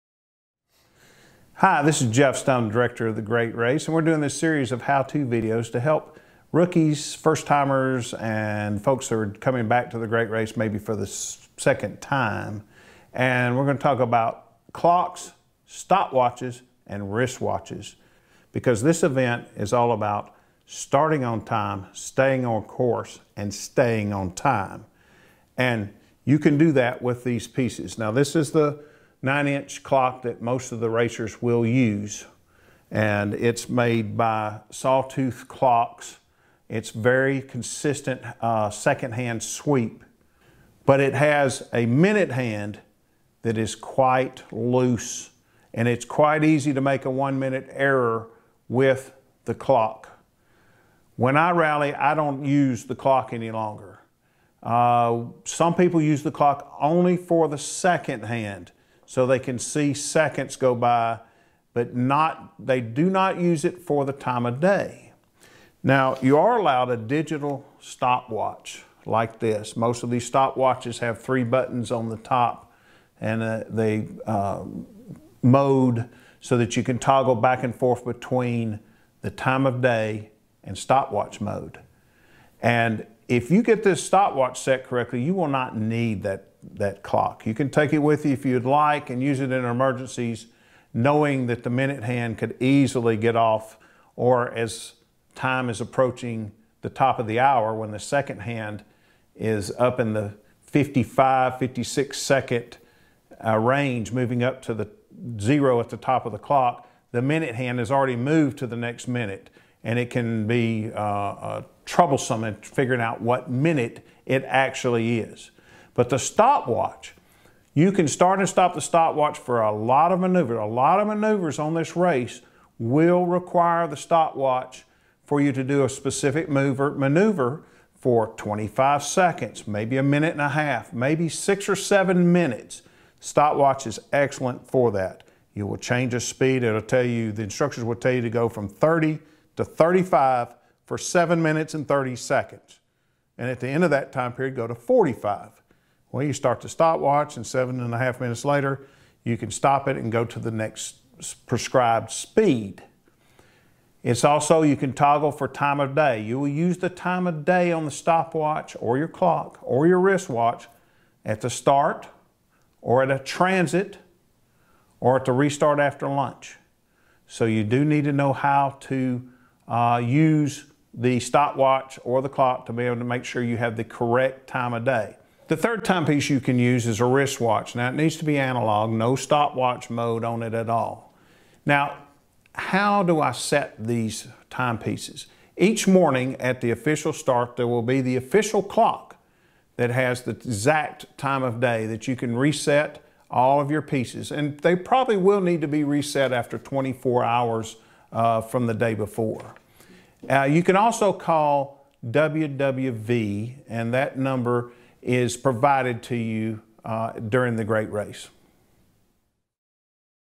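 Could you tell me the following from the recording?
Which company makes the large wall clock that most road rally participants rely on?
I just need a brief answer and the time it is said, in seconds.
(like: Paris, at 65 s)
Sawtooth Clocks, at 34 s.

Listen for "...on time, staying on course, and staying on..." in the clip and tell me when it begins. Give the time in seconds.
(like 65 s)
21 s.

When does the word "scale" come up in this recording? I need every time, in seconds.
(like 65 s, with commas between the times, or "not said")
not said.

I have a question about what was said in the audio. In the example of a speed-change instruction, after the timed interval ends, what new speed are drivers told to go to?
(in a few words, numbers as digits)
45.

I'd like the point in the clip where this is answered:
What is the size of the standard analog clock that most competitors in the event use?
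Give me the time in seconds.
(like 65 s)
29 s.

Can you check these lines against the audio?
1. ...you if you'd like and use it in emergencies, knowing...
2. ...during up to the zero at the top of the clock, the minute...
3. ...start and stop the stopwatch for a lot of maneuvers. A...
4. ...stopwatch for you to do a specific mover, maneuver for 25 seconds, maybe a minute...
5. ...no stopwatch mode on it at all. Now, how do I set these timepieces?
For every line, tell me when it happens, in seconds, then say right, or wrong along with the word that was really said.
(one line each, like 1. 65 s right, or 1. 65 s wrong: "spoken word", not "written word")
1. 88 s right
2. 104 s wrong: "moving", not "during"
3. 118 s right
4. 123 s right
5. 178 s right.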